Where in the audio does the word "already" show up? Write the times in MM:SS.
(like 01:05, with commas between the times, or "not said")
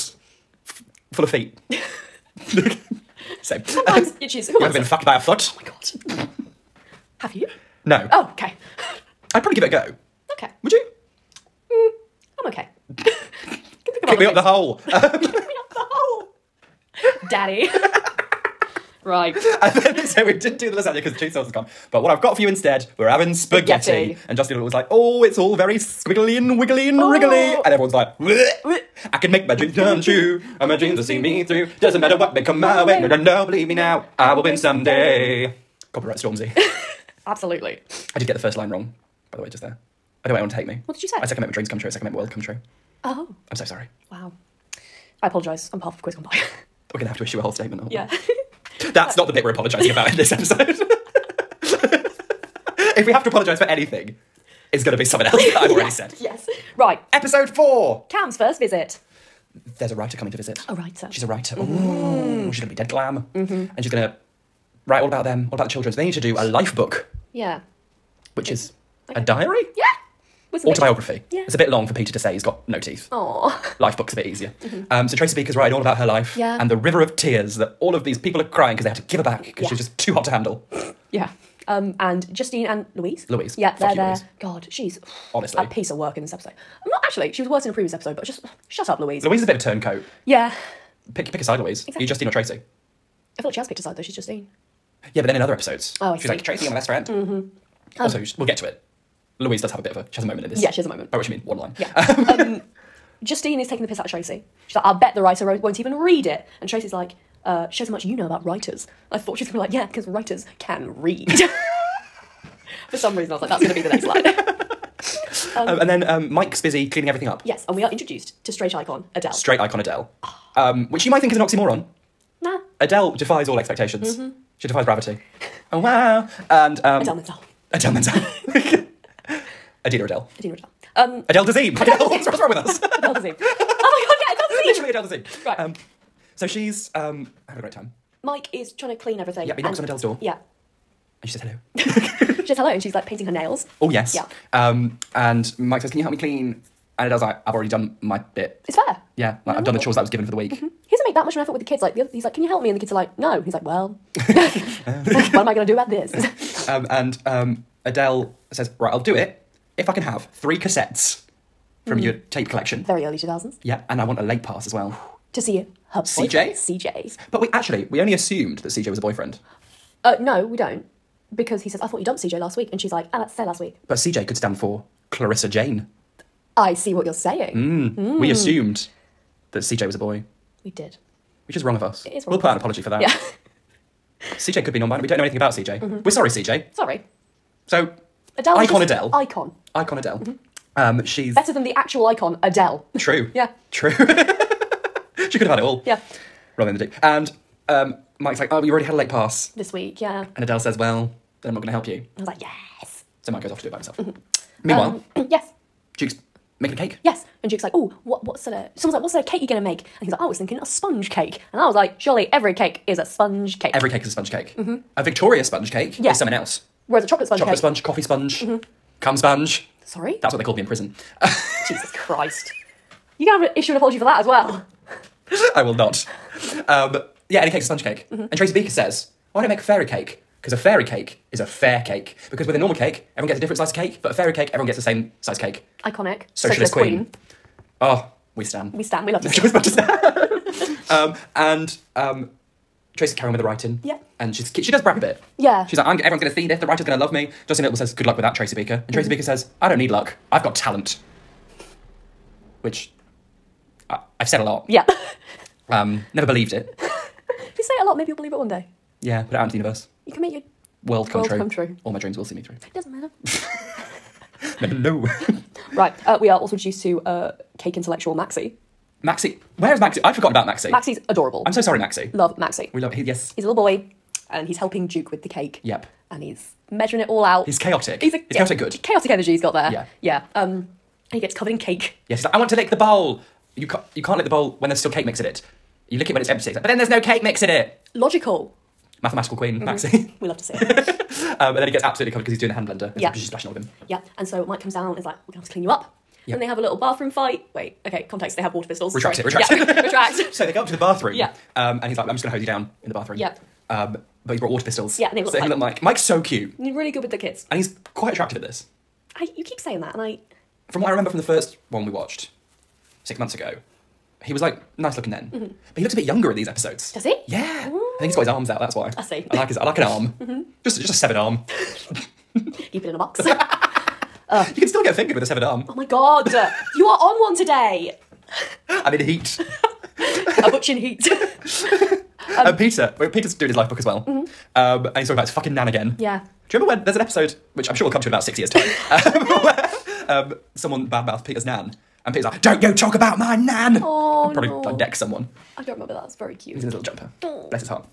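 00:55, 02:27, 03:18.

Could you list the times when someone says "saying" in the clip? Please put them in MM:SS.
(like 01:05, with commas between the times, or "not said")
02:57, 05:09.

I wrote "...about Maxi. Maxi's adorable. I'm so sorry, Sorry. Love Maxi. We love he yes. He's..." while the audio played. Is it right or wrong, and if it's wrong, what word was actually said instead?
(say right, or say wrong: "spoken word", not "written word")
wrong: "Maxi", not "Sorry".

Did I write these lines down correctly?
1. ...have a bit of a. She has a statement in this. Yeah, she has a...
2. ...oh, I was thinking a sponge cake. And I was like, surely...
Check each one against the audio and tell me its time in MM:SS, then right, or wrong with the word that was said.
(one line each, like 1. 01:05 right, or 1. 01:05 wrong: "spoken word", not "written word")
1. 01:39 wrong: "moment", not "statement"
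2. 03:30 right.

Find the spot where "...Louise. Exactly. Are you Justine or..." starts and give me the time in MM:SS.
01:31.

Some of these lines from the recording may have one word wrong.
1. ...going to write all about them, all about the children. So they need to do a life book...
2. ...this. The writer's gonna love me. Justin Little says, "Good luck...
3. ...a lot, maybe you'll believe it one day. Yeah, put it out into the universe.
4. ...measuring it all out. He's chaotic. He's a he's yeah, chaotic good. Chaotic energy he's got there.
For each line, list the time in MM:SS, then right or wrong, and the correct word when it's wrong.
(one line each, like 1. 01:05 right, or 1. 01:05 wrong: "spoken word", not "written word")
1. 01:03 right
2. 04:06 right
3. 04:17 right
4. 04:36 right.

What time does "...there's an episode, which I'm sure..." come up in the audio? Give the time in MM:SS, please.
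05:36.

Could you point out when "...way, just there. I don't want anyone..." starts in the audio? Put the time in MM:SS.
00:39.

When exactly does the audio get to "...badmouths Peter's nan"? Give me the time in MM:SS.
05:40.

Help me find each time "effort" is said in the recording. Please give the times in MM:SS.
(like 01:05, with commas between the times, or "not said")
02:31.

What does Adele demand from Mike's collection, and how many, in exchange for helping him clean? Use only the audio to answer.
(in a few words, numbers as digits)
3 cassettes.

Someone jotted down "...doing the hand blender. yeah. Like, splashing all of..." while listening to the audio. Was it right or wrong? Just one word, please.
right.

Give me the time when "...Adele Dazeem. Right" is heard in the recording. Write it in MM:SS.
02:14.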